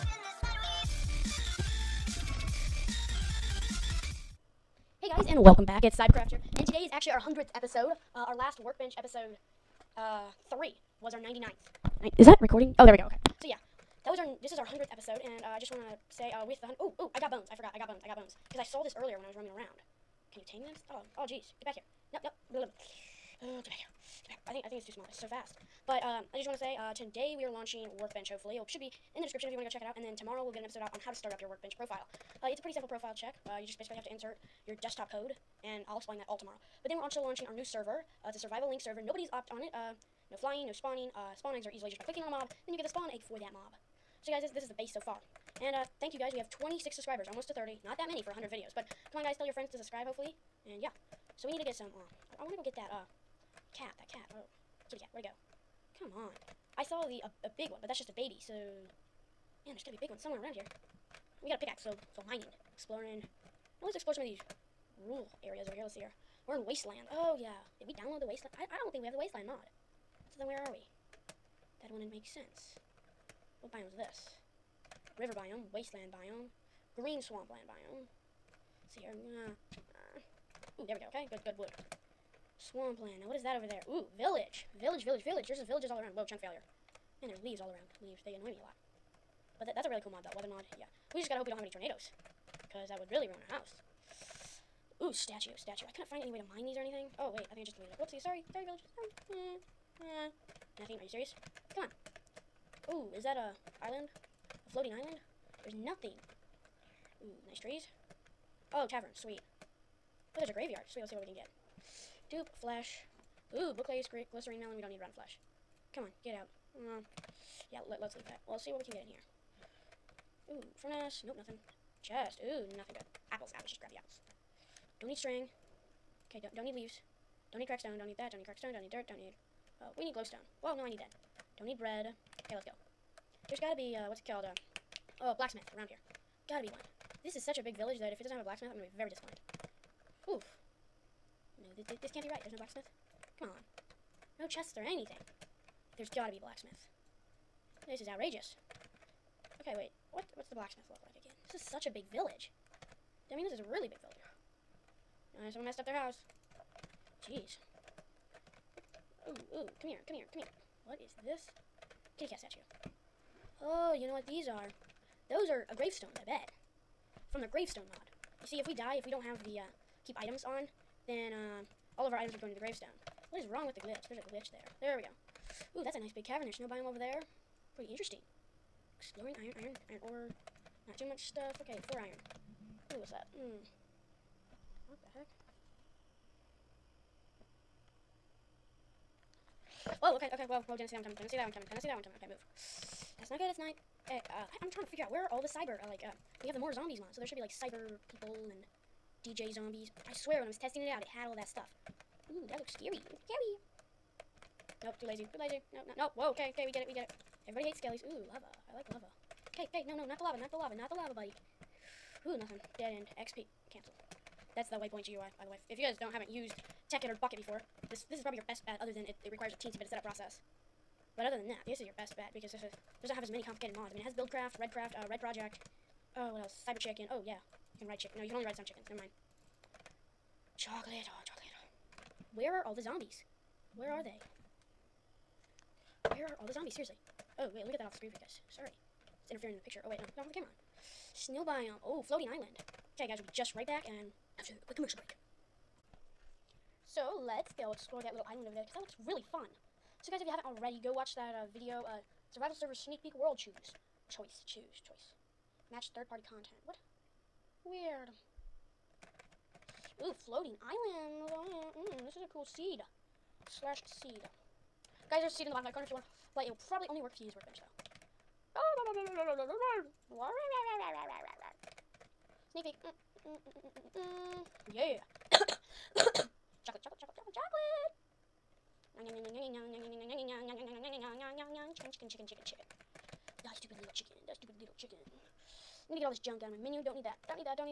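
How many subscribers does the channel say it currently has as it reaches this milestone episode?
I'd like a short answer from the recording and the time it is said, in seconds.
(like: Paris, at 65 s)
26, at 46 s.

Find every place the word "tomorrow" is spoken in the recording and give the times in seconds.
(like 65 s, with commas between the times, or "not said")
30 s, 36 s.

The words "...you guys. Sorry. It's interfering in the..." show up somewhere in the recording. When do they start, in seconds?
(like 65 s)
238 s.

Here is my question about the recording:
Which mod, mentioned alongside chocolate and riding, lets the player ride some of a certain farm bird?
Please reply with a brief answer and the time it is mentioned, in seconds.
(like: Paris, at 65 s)
Cyber Chicken, at 226 s.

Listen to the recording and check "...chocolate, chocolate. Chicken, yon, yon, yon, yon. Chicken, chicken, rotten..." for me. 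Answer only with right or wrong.
wrong.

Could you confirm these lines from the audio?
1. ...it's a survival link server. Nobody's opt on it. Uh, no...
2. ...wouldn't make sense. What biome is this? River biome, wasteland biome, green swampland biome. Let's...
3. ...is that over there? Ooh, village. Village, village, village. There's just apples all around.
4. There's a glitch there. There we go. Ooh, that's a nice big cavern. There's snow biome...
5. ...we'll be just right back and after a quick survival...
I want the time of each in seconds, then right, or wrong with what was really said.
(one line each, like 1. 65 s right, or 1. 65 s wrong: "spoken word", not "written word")
1. 38 s right
2. 71 s right
3. 83 s wrong: "villages", not "apples"
4. 174 s right
5. 243 s wrong: "commercial", not "survival".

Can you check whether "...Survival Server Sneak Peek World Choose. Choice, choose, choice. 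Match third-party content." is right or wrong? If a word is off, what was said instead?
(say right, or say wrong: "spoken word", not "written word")
right.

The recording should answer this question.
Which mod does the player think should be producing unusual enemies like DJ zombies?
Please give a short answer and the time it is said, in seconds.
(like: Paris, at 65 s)
more zombies mod, at 196 s.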